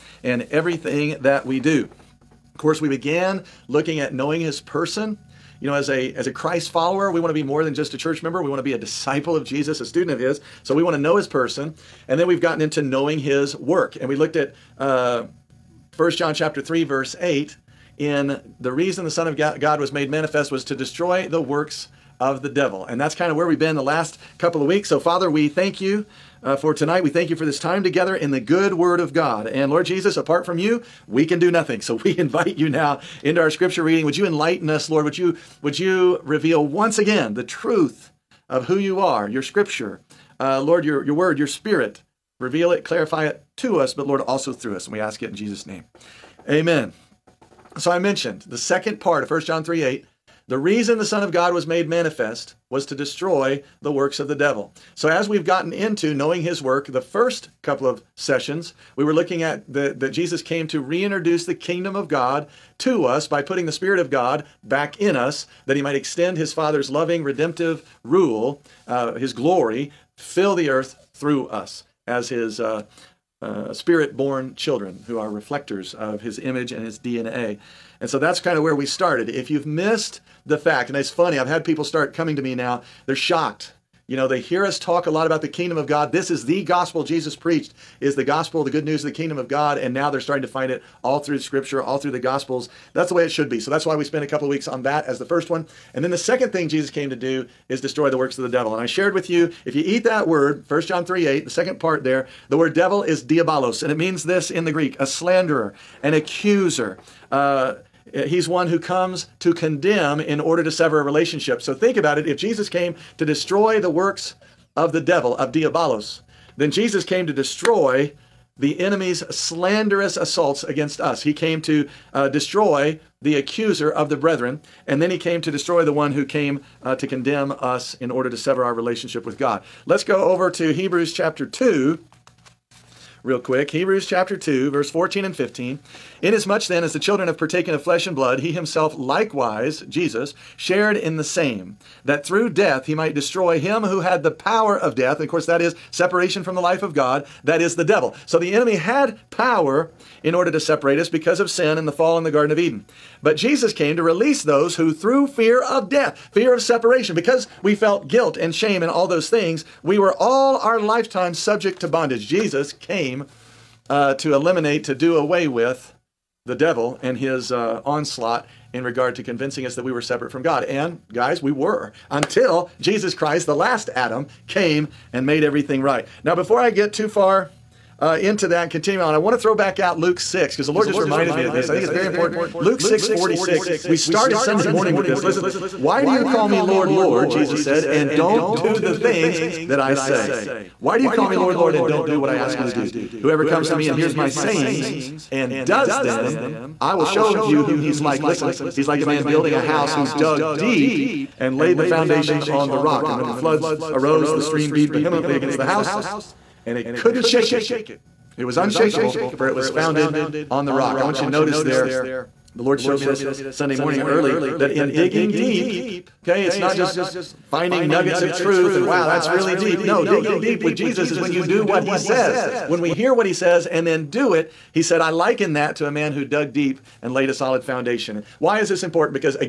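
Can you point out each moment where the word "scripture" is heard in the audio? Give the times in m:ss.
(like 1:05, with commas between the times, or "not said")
0:33, 0:39, 1:31.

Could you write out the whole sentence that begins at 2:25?
And of course, that is separation from the life of God, that is the devil.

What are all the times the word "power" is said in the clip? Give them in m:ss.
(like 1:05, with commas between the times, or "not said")
2:24, 2:29.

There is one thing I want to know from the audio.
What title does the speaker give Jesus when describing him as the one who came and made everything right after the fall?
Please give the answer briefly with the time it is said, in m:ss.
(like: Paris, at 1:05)
the last Adam, at 2:53.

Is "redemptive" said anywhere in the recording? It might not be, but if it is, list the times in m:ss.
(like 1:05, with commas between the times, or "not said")
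1:07.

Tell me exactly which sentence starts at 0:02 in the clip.
Of course, we began looking at knowing his person.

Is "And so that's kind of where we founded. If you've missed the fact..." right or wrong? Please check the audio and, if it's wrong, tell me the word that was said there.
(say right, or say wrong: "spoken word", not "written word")
wrong: "started", not "founded".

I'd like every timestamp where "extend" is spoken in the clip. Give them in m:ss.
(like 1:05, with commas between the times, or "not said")
1:05.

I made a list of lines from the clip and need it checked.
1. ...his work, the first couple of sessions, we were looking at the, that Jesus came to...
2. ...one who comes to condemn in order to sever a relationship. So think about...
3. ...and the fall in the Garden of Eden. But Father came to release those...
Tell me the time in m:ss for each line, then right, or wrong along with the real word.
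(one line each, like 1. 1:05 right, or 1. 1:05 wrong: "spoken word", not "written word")
1. 0:56 right
2. 1:48 right
3. 2:31 wrong: "Jesus", not "Father".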